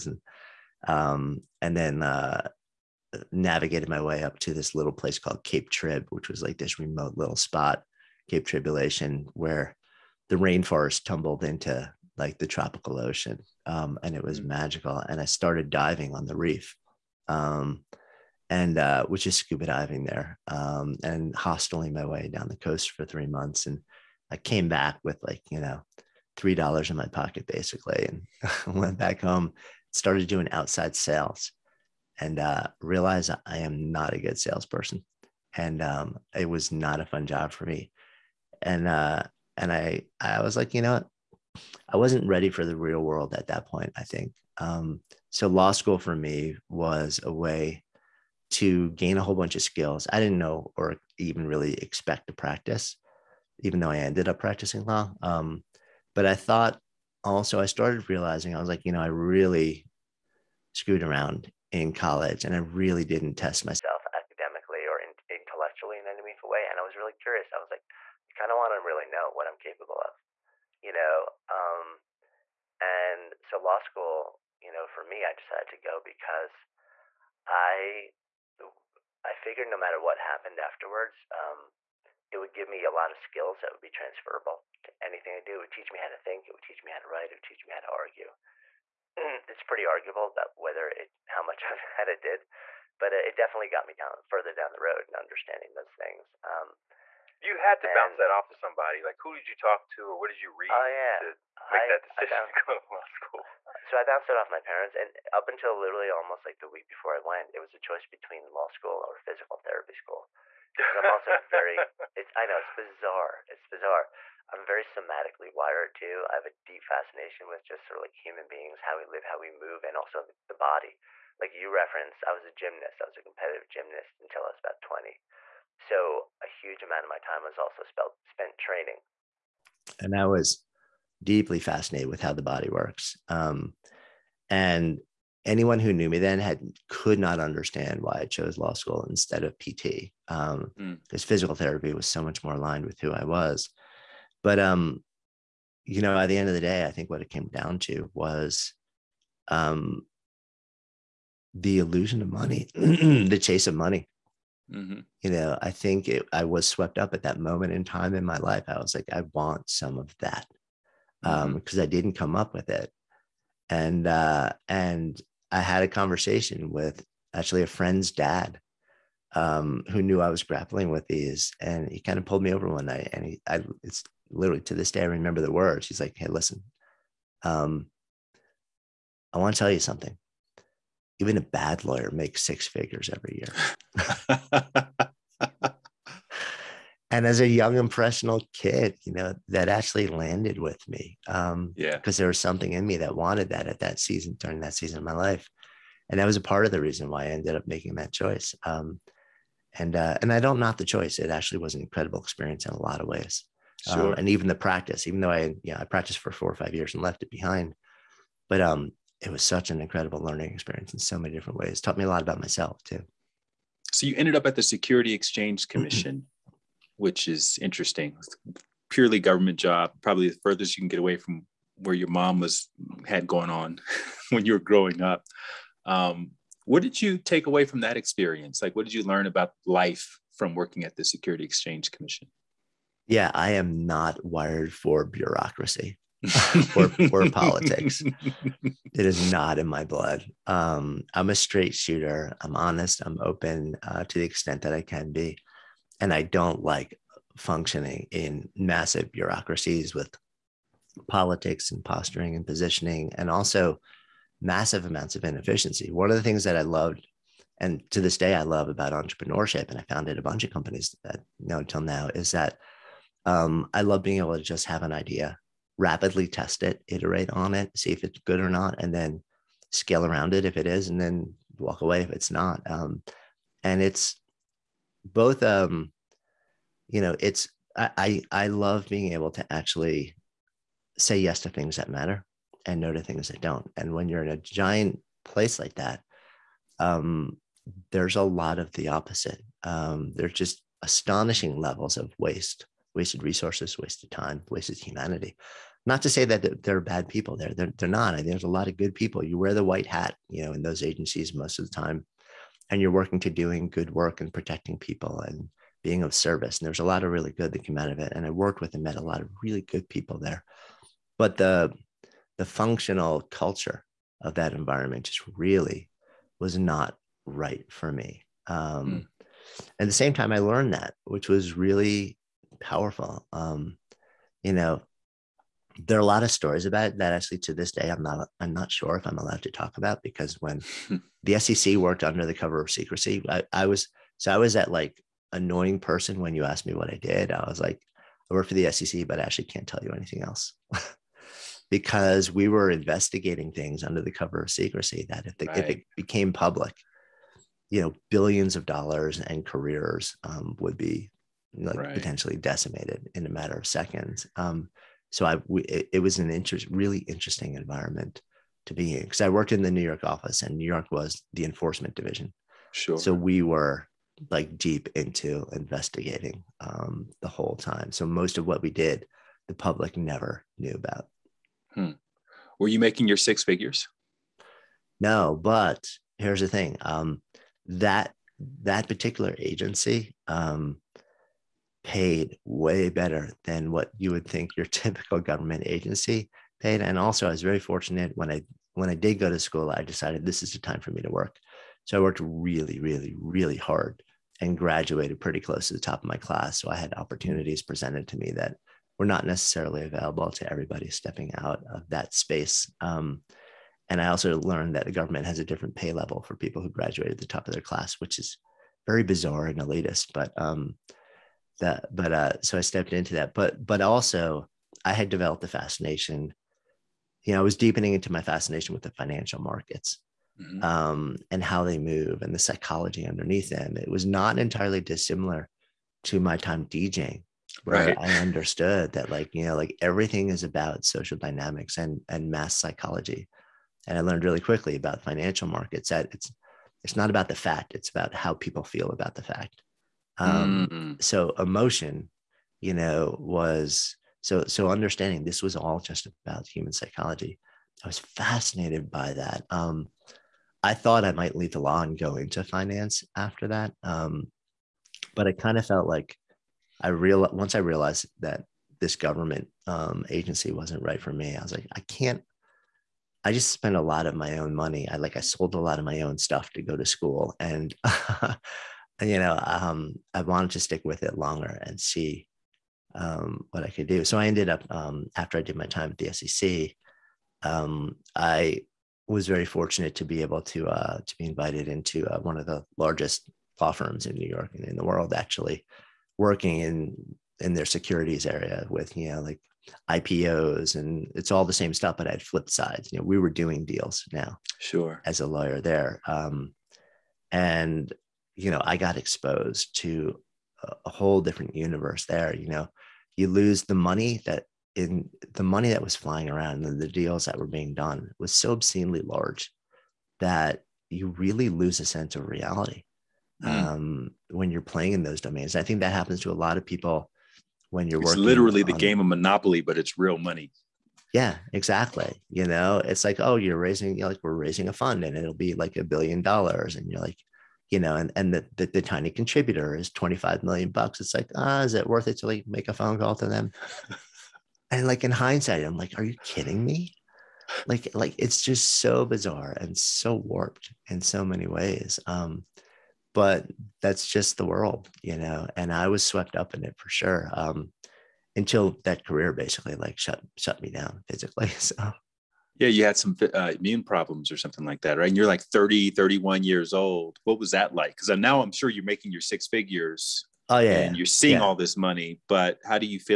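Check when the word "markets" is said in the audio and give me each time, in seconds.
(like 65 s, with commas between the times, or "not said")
419 s, 435 s.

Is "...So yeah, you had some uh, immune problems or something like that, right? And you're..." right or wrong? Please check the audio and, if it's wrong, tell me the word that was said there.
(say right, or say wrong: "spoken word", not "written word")
right.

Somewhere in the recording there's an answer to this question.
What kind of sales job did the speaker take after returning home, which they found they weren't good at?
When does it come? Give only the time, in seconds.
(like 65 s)
30 s.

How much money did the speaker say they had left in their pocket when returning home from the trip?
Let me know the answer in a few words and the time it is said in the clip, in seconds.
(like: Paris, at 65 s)
$3, at 26 s.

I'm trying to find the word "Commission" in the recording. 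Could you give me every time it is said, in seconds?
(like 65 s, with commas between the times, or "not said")
215 s, 231 s.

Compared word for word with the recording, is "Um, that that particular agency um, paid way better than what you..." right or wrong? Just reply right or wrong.
right.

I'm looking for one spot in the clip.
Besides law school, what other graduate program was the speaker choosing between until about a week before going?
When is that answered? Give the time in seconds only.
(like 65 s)
109 s.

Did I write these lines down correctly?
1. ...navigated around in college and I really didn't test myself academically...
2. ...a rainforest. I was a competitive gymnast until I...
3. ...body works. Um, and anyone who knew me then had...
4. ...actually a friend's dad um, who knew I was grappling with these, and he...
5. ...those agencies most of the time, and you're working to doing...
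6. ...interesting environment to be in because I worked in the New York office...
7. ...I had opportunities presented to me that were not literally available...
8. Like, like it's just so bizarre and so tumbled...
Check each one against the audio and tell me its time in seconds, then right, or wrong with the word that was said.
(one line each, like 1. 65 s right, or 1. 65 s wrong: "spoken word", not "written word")
1. 60 s wrong: "screwed", not "navigated"
2. 122 s wrong: "gymnast", not "rainforest"
3. 132 s right
4. 167 s right
5. 300 s right
6. 357 s right
7. 396 s wrong: "necessarily", not "literally"
8. 537 s wrong: "warped", not "tumbled".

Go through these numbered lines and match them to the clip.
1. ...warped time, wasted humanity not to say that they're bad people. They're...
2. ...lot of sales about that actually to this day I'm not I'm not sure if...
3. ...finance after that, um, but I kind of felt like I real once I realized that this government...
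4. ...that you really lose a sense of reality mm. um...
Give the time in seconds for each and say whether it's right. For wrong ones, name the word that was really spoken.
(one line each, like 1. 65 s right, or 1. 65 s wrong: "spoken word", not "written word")
1. 293 s wrong: "wasted", not "warped"
2. 326 s wrong: "stories", not "sales"
3. 452 s right
4. 510 s right.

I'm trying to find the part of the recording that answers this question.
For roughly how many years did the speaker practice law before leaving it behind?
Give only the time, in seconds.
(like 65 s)
206 s.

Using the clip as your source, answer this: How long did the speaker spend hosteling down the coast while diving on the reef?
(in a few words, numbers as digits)
3 months.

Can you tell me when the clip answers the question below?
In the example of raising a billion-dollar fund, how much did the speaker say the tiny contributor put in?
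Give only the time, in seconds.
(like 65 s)
529 s.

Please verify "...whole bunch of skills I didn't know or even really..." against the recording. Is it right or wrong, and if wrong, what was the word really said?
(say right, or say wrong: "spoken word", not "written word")
right.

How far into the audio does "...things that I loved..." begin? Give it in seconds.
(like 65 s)
256 s.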